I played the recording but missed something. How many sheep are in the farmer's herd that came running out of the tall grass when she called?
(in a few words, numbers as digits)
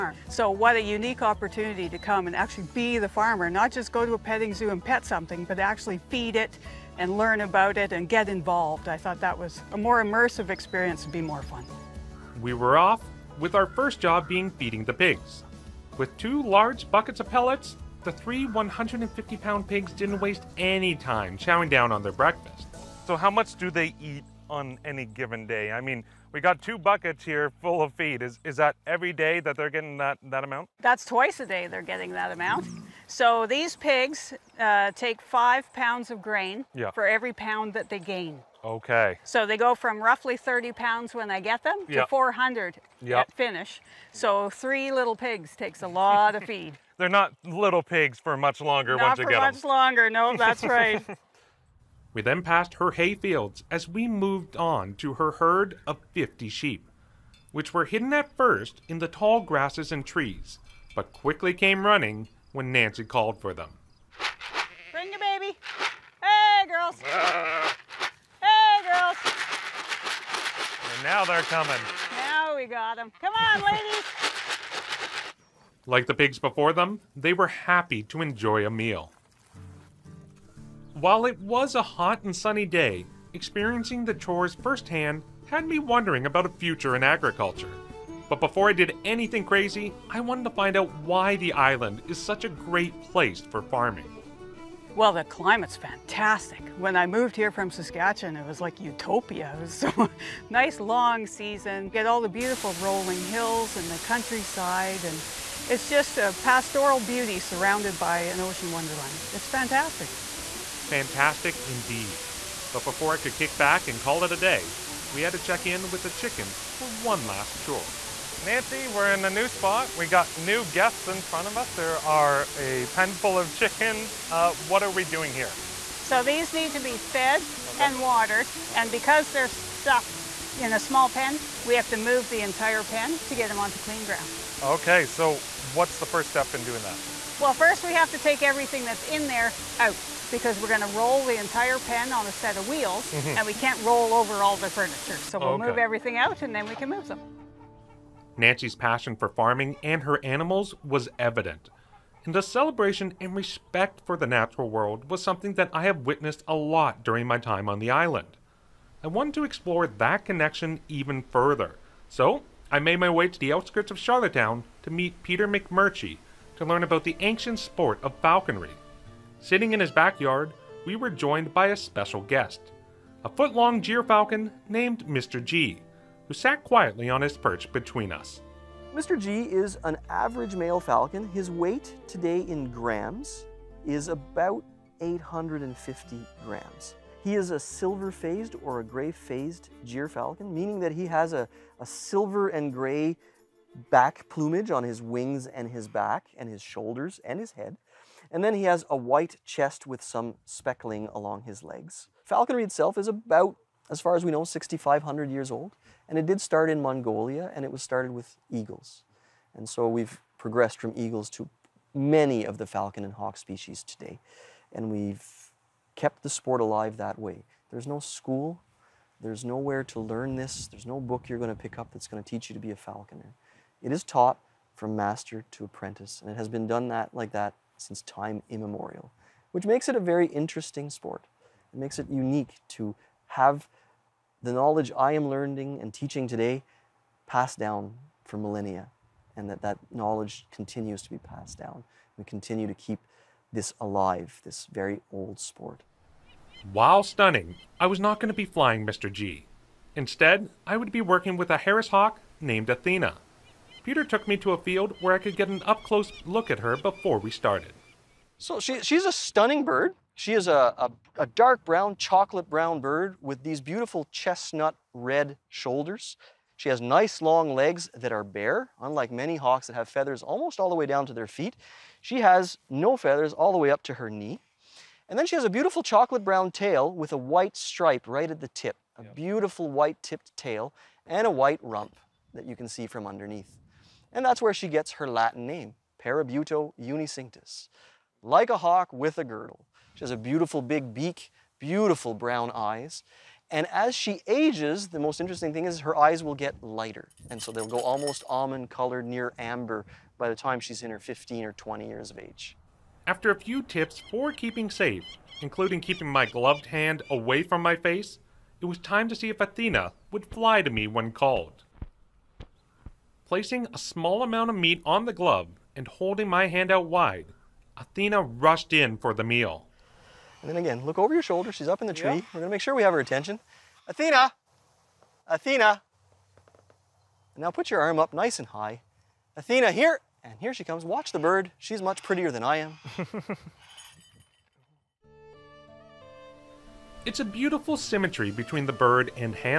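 50.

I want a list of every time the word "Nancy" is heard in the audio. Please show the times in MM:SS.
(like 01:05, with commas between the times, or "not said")
01:02, 01:58, 02:28.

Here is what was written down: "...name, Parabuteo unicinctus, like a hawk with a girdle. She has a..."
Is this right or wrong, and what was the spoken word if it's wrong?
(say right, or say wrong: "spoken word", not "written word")
right.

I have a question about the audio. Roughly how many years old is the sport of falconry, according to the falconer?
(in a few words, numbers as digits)
6,500.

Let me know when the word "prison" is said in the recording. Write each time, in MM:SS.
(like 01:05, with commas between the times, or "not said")
not said.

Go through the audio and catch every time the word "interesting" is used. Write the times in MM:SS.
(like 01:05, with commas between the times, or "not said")
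03:50, 04:55.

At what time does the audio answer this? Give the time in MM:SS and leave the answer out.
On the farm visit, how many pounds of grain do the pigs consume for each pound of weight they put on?
00:35.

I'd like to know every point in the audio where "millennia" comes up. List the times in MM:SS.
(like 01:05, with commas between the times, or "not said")
03:58.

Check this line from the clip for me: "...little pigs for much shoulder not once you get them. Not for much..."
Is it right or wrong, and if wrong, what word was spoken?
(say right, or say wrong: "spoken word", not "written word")
wrong: "longer", not "shoulder".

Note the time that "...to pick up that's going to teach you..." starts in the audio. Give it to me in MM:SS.
03:41.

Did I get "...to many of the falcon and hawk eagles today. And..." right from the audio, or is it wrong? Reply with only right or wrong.
wrong.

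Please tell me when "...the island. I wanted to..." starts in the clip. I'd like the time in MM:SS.
02:37.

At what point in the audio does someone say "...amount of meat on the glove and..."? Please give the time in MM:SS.
05:14.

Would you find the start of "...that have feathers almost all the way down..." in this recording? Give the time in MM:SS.
04:29.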